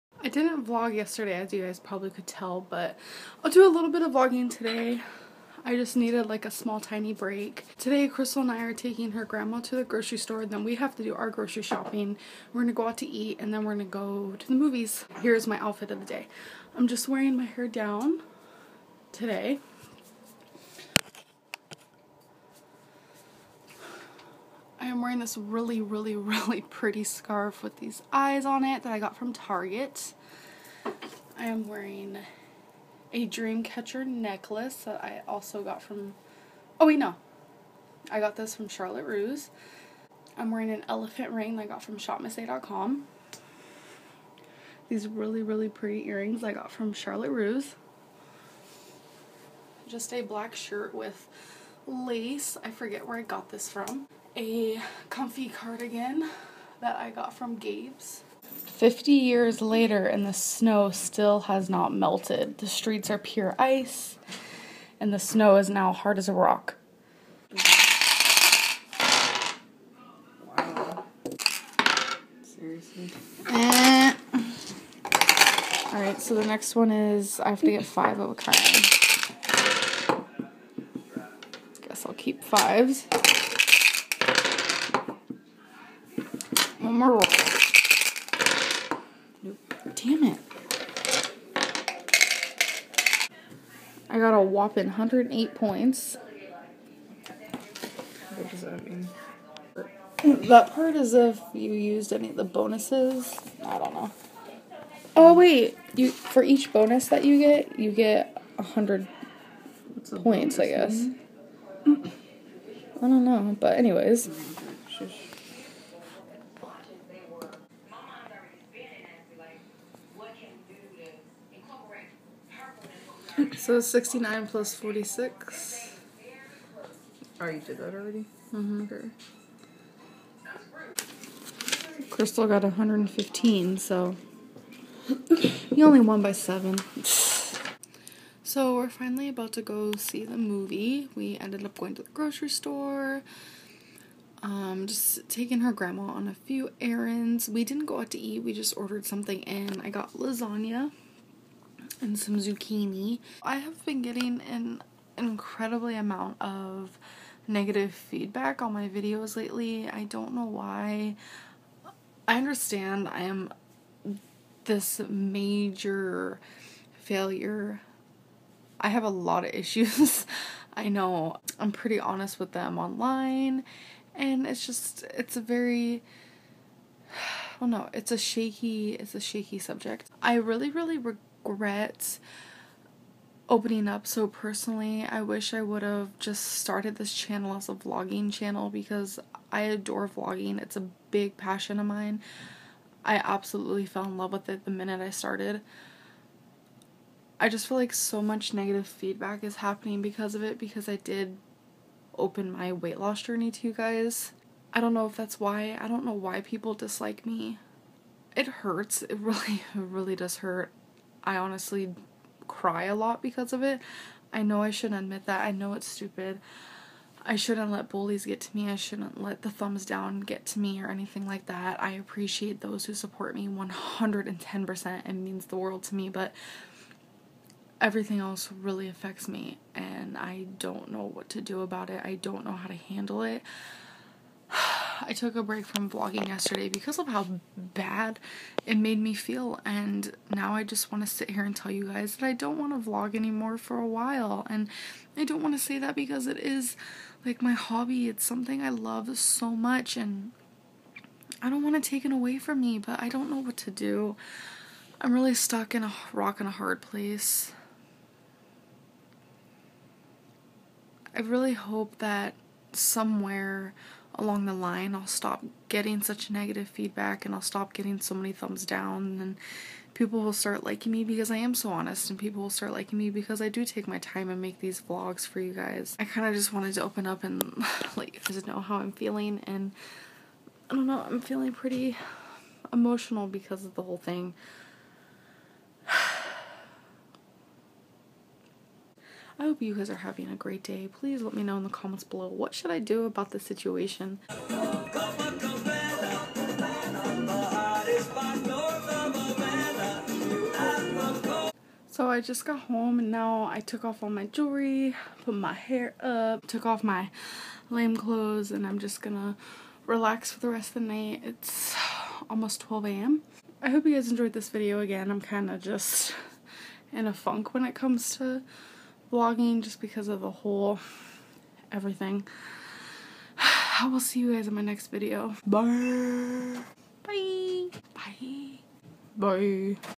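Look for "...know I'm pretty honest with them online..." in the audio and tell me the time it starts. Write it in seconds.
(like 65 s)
170 s.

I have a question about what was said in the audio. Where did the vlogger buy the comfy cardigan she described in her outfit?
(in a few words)
Gabe's.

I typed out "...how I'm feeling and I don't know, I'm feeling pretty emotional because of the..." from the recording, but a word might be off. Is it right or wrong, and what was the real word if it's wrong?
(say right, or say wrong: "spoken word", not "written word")
right.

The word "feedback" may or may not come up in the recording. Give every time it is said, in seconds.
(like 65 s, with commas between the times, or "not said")
157 s, 198 s, 266 s.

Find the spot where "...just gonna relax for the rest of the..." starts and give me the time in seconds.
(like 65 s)
308 s.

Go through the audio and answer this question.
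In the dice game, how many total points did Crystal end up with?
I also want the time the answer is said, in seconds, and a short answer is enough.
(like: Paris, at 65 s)
115, at 132 s.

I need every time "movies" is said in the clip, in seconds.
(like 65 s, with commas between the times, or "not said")
14 s, 140 s.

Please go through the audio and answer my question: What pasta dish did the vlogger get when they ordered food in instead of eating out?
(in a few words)
lasagna.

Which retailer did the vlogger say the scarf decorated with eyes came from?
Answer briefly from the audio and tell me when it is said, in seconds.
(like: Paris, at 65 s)
Target, at 29 s.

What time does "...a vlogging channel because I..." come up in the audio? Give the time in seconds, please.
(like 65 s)
187 s.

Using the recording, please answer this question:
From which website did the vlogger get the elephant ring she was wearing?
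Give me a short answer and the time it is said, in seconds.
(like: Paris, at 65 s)
shopmissa.com, at 41 s.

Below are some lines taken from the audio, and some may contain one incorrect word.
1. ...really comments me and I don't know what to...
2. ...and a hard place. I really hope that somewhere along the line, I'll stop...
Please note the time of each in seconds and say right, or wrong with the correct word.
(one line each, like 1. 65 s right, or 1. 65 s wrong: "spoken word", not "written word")
1. 228 s wrong: "affects", not "comments"
2. 256 s right.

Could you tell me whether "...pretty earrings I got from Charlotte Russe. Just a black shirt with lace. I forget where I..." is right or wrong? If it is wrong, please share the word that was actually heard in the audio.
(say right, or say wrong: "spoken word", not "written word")
right.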